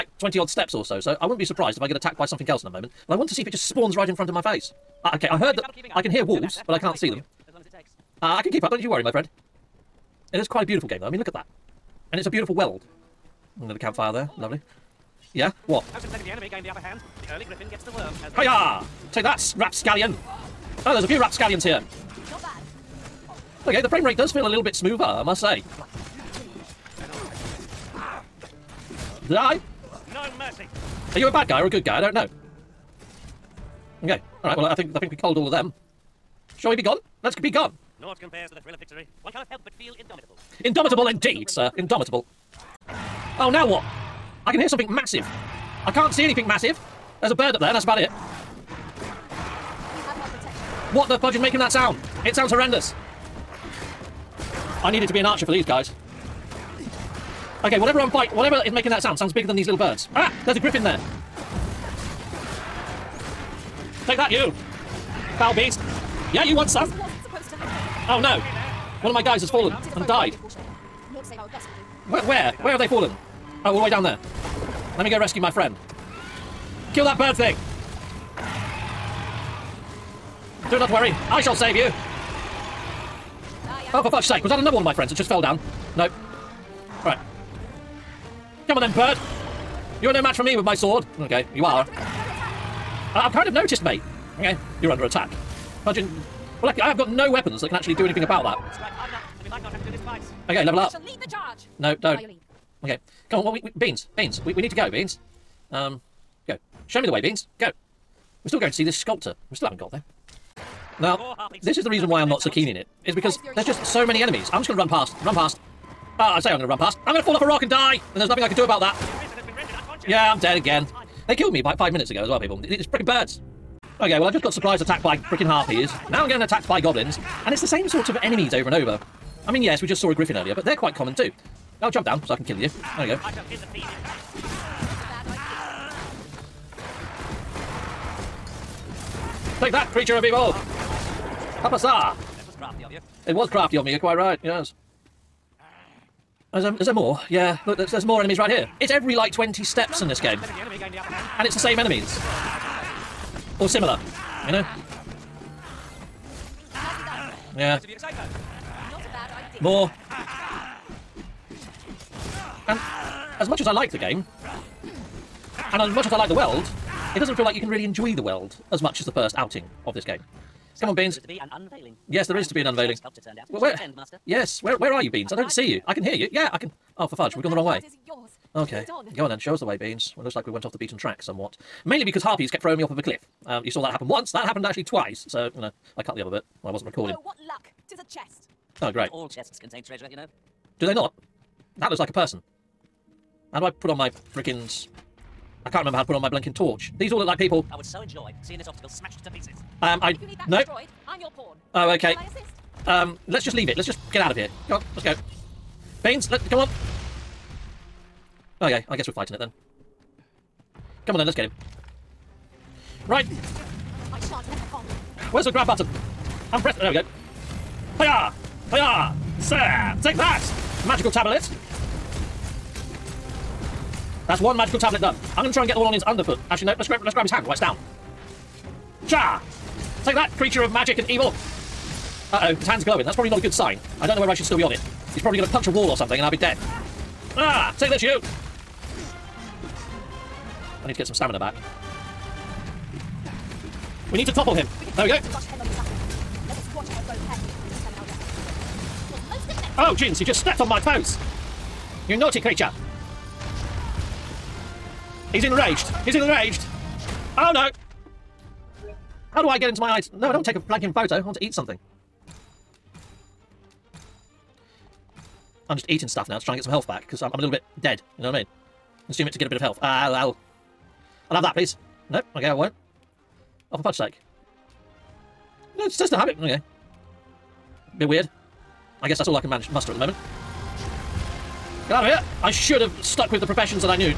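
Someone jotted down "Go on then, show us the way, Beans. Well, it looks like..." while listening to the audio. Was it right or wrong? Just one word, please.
right.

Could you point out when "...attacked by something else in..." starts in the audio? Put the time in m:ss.
0:01.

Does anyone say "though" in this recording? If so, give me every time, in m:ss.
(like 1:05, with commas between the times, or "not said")
0:11.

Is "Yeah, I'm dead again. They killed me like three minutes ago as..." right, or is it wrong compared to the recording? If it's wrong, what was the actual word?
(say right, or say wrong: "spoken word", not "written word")
wrong: "five", not "three".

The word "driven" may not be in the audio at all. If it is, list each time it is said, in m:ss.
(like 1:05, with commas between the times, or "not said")
not said.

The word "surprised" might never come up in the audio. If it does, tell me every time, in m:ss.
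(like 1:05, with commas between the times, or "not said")
0:01, 2:04.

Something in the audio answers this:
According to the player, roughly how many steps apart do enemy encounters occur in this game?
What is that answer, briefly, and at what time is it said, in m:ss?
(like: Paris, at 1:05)
20, at 2:28.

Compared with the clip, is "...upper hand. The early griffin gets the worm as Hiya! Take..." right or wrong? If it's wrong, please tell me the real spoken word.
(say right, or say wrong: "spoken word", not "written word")
right.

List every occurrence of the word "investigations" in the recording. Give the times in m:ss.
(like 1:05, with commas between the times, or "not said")
not said.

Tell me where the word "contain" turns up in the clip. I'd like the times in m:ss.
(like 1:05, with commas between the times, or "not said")
3:09.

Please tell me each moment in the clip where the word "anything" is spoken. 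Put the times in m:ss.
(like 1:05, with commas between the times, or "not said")
0:46, 1:38.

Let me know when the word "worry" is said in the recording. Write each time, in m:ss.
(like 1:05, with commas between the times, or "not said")
0:08, 1:20.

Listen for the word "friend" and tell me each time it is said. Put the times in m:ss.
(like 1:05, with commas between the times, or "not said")
0:09, 1:15, 1:24.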